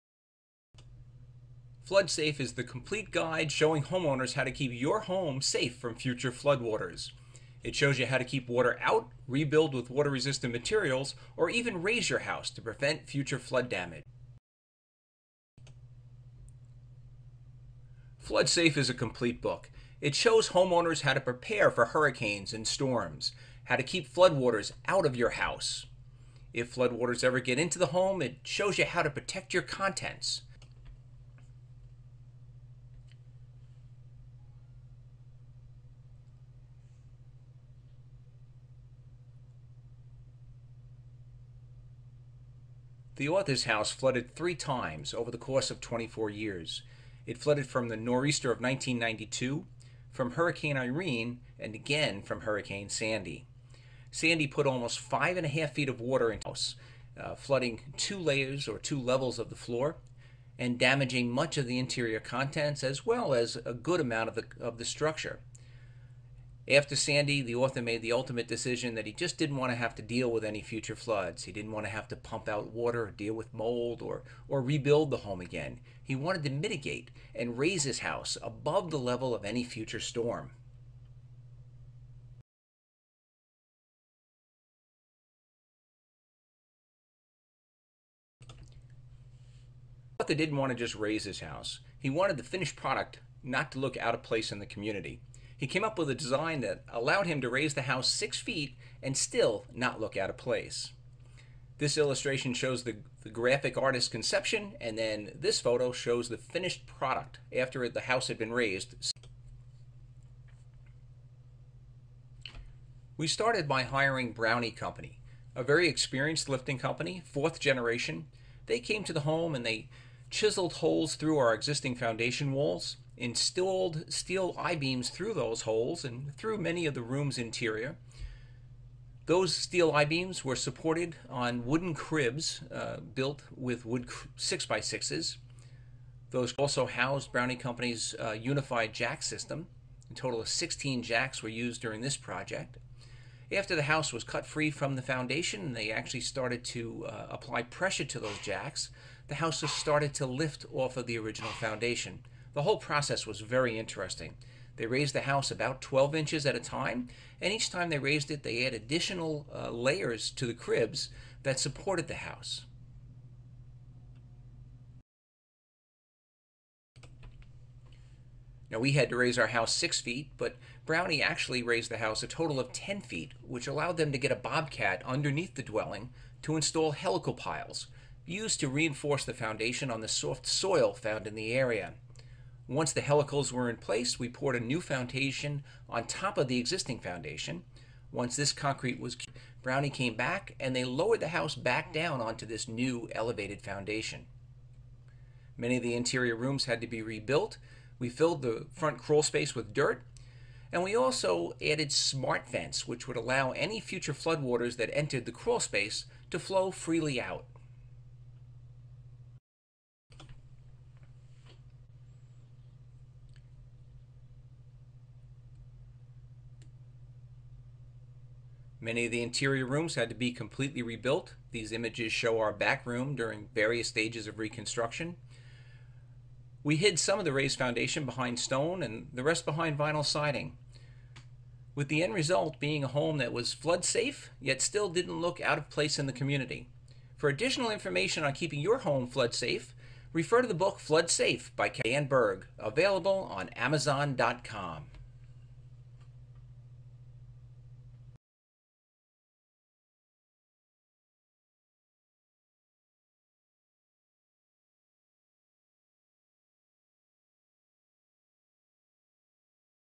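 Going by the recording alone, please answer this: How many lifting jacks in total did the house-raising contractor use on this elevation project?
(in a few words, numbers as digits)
16.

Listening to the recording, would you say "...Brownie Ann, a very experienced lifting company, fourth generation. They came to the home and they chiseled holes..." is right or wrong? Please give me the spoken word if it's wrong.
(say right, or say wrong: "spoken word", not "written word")
wrong: "Company", not "Ann".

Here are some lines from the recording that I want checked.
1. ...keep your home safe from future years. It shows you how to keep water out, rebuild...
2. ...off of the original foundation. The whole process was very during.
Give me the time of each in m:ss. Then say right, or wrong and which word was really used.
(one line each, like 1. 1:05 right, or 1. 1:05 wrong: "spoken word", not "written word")
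1. 0:04 wrong: "floodwaters", not "years"
2. 2:30 wrong: "interesting", not "during".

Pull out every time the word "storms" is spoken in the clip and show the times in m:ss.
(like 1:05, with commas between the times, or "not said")
0:22, 1:19.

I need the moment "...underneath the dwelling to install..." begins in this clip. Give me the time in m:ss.
2:55.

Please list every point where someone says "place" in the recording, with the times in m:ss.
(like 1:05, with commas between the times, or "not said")
1:34, 1:40, 3:03, 3:55.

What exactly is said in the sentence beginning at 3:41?
These images show our back room during various stages of reconstruction.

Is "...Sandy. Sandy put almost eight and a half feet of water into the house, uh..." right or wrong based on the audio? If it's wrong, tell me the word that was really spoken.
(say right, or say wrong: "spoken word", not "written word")
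wrong: "five", not "eight".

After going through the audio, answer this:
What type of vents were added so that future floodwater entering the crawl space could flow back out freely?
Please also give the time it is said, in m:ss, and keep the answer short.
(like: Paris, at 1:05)
smart vents, at 3:21.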